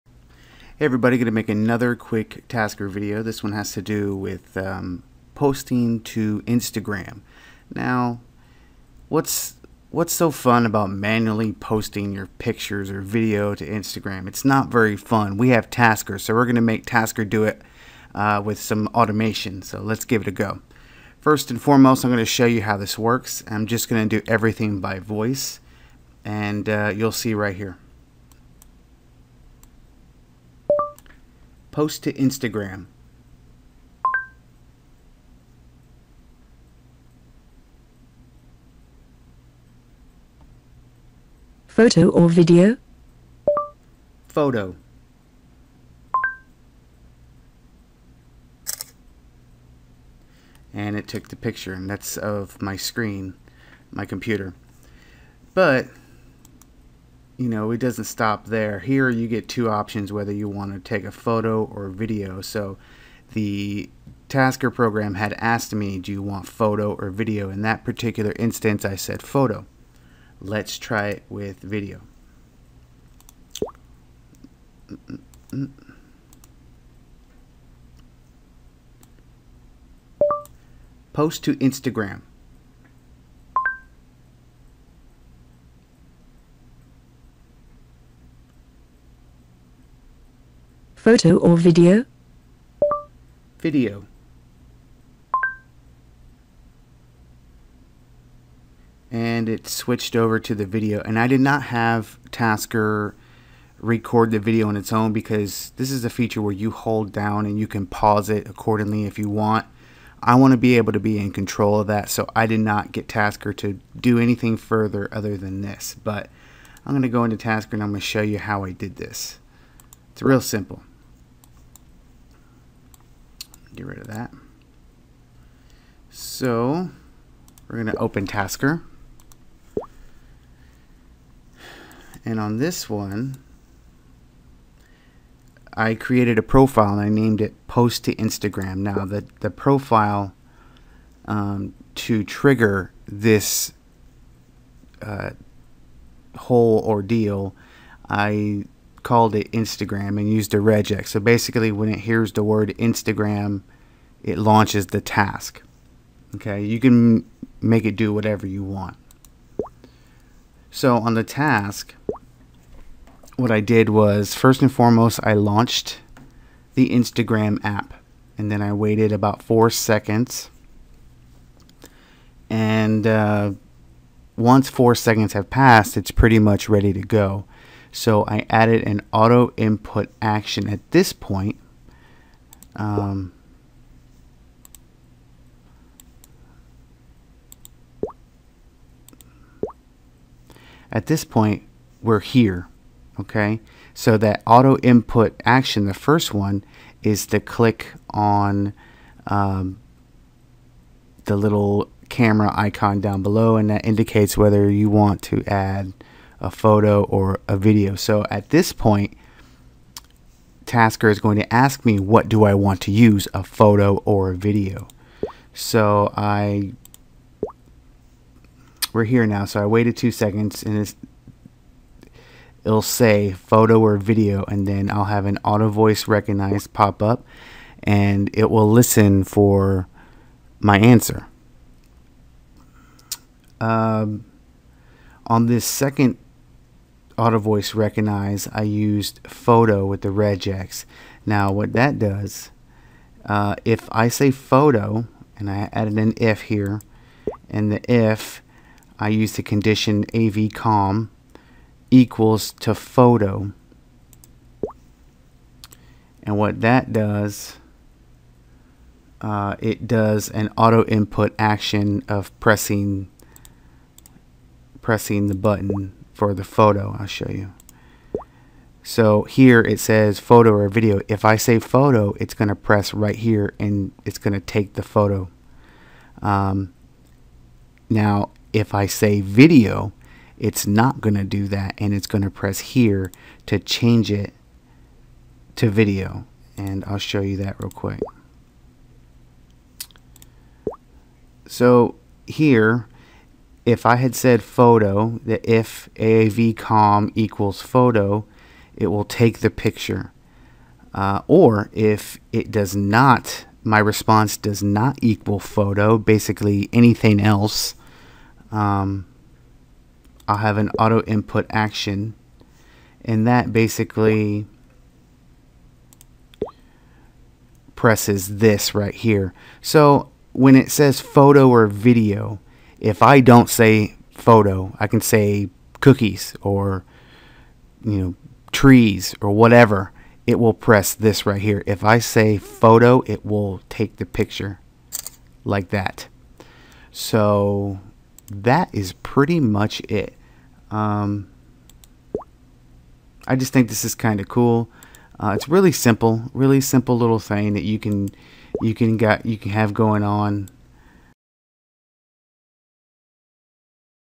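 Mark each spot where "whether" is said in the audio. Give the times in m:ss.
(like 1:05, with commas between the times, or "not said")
1:00, 3:24.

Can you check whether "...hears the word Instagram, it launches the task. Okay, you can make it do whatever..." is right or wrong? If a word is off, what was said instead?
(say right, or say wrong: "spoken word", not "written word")
right.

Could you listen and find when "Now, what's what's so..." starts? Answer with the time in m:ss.
0:07.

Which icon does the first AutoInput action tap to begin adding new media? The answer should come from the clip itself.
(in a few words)
camera icon.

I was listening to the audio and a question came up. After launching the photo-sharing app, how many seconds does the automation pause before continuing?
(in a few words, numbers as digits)
4.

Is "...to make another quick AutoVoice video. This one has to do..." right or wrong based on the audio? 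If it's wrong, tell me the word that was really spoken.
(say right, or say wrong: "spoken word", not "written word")
wrong: "Tasker", not "AutoVoice".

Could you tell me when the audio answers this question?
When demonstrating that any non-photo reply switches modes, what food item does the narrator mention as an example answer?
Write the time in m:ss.
5:25.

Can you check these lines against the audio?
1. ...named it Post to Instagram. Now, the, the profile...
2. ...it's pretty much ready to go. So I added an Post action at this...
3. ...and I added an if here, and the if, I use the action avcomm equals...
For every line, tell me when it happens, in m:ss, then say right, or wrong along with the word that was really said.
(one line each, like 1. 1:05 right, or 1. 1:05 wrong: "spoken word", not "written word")
1. 2:17 right
2. 2:55 wrong: "AutoInput", not "Post"
3. 4:05 wrong: "condition", not "action".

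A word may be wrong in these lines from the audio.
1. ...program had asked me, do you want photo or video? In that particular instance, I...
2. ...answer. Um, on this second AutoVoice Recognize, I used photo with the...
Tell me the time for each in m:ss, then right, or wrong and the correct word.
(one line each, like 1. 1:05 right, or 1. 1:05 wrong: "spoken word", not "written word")
1. 1:04 right
2. 3:50 right.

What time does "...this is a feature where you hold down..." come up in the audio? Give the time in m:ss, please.
1:45.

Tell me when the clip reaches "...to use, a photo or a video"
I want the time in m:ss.
3:32.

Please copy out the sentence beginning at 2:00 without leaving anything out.
It's real simple get rid of that.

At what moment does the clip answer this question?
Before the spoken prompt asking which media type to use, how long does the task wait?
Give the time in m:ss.
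3:39.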